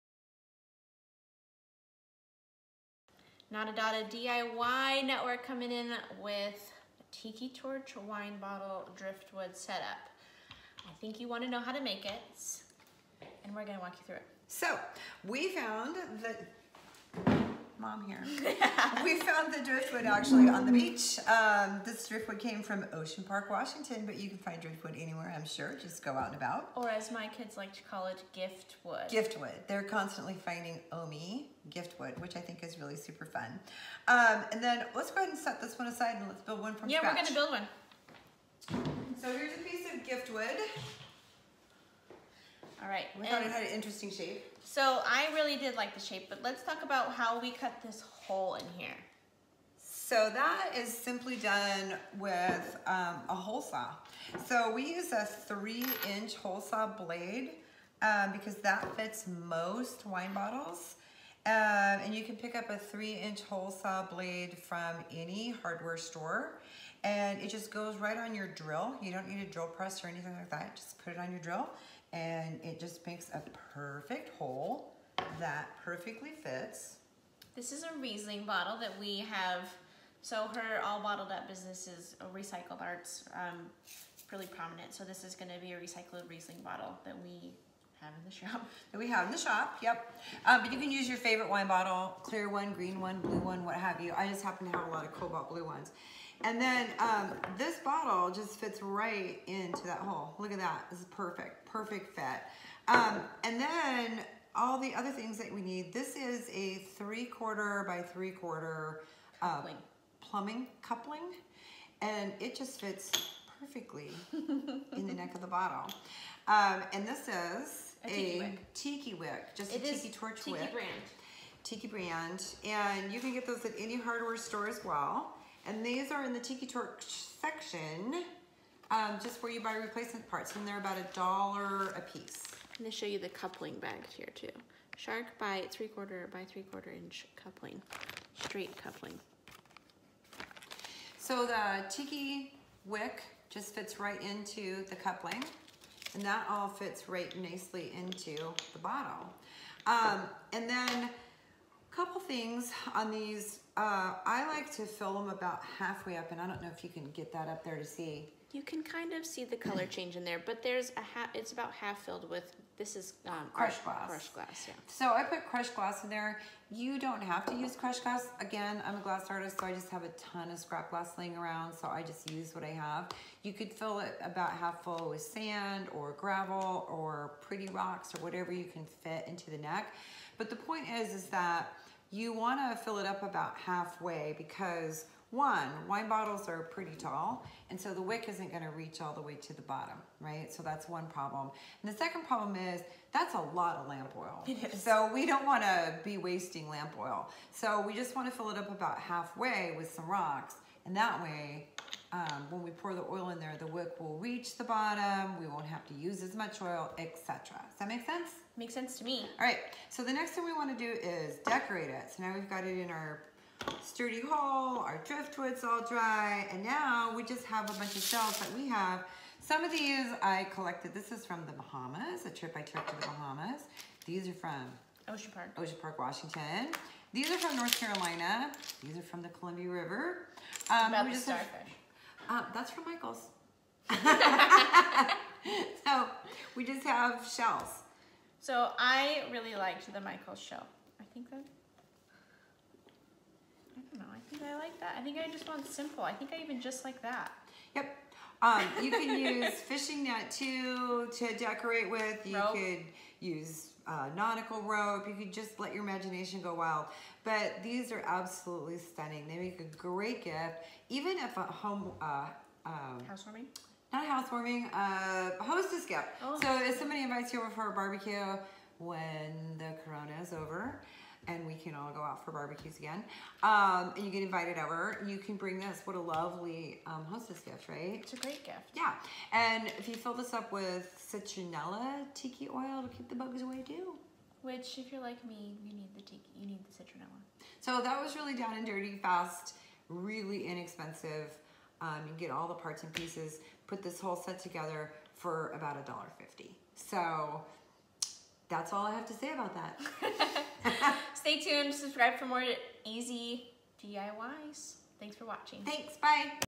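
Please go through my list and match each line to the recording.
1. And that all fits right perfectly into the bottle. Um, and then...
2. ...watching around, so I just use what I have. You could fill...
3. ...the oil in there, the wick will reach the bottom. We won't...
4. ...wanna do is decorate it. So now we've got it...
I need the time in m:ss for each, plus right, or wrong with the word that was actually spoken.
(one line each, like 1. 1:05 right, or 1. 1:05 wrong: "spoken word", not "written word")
1. 2:26 wrong: "nicely", not "perfectly"
2. 2:51 wrong: "laying", not "watching"
3. 3:22 right
4. 3:30 right.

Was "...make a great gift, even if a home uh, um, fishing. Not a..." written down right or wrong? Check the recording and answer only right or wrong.
wrong.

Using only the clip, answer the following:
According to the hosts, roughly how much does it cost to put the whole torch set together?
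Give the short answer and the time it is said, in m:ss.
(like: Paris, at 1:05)
$1.50, at 4:55.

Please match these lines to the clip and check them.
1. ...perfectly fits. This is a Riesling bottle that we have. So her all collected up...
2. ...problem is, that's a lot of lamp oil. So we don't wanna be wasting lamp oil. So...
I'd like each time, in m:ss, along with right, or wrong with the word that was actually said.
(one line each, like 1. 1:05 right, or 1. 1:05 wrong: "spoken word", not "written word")
1. 1:15 wrong: "bottled", not "collected"
2. 3:12 right.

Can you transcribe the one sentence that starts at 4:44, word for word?
Which, if you're like me, you need the tiki, you need the citronella.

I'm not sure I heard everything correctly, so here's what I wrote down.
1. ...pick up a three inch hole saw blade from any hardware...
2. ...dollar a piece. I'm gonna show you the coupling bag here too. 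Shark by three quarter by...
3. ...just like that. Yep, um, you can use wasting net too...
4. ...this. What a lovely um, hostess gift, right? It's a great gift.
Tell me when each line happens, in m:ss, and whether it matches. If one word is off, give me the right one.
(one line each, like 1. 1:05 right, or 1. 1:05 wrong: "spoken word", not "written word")
1. 1:02 right
2. 2:11 right
3. 4:06 wrong: "fishing", not "wasting"
4. 4:35 right.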